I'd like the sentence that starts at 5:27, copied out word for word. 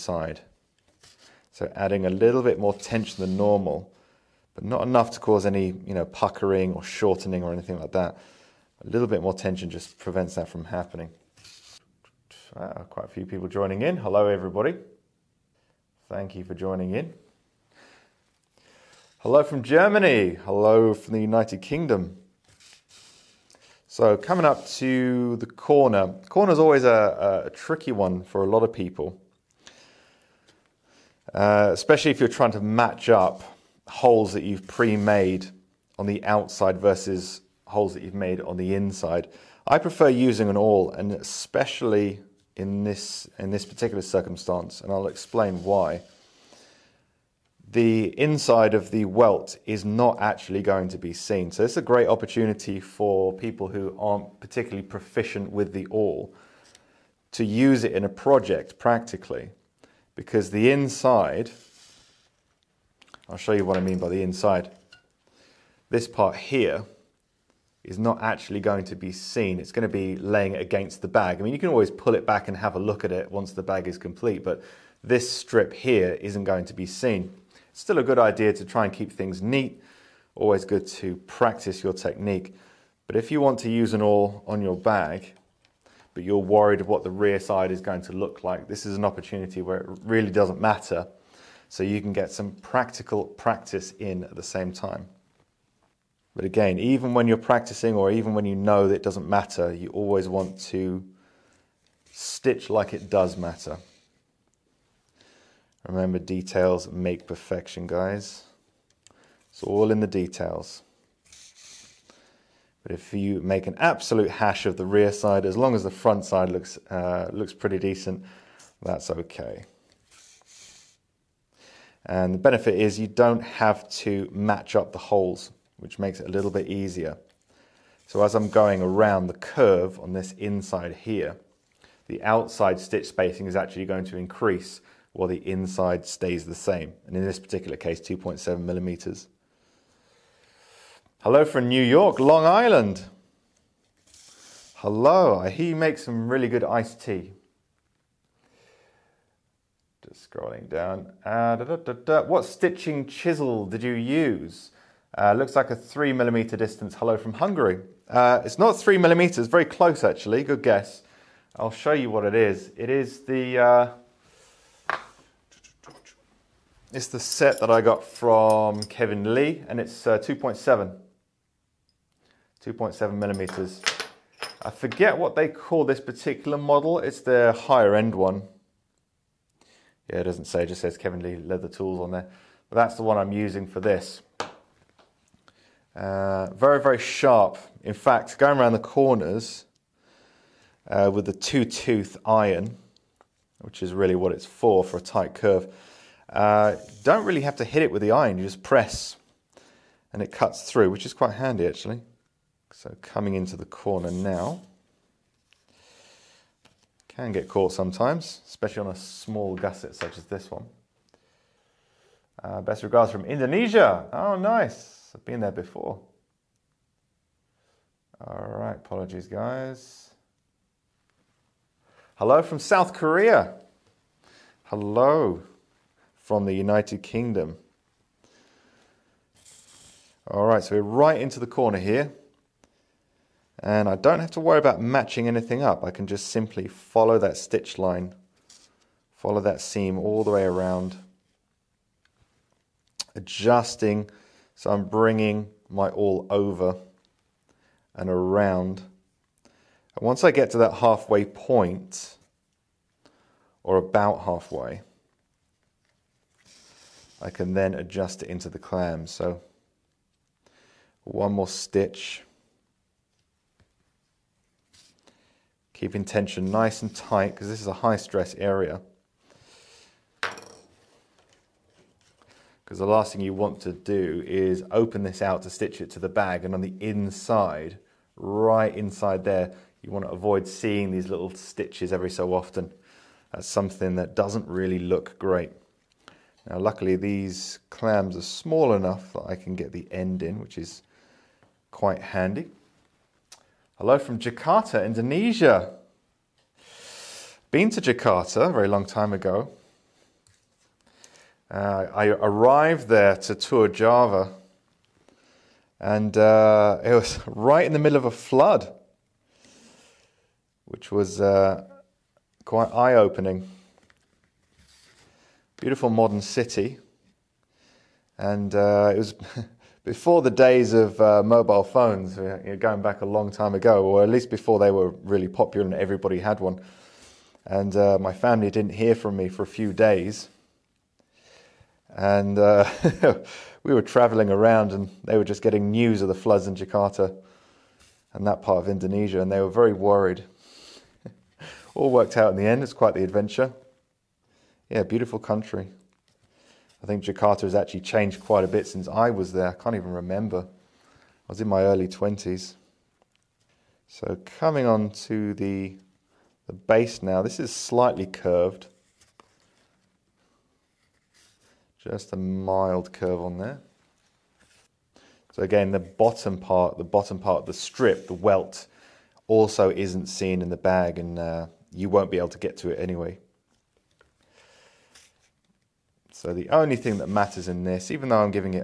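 And uh, my family didn't hear from me for a few days.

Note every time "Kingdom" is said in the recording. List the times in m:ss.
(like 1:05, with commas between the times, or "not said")
0:21, 3:47.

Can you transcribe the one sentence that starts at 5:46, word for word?
I think Jakarta has actually changed quite a bit since I was there.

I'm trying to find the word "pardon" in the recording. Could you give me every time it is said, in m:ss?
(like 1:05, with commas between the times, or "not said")
not said.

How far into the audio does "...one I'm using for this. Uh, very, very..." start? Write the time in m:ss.
3:03.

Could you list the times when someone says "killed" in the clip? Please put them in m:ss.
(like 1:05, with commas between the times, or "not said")
not said.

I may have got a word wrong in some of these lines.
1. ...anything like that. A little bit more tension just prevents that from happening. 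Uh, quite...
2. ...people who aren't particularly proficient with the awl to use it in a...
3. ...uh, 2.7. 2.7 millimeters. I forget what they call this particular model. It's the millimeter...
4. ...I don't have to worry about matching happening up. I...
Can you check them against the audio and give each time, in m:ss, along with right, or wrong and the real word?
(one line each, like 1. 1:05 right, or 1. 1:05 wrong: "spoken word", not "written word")
1. 0:07 right
2. 0:53 right
3. 2:50 wrong: "higher", not "millimeter"
4. 3:53 wrong: "anything", not "happening".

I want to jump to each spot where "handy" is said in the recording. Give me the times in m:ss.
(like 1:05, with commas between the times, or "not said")
3:21, 4:52.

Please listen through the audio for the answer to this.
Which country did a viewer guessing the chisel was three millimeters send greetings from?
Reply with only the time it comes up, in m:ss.
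2:37.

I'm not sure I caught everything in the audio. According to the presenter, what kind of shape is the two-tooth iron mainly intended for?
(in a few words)
a tight curve.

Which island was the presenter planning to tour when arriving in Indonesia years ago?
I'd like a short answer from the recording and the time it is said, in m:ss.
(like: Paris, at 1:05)
Java, at 5:03.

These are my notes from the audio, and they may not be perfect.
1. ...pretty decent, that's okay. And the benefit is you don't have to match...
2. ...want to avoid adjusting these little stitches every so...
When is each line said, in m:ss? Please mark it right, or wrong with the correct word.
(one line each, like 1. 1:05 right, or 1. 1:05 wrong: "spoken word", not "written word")
1. 1:57 right
2. 4:39 wrong: "seeing", not "adjusting".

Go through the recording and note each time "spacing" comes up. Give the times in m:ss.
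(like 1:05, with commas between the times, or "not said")
2:13.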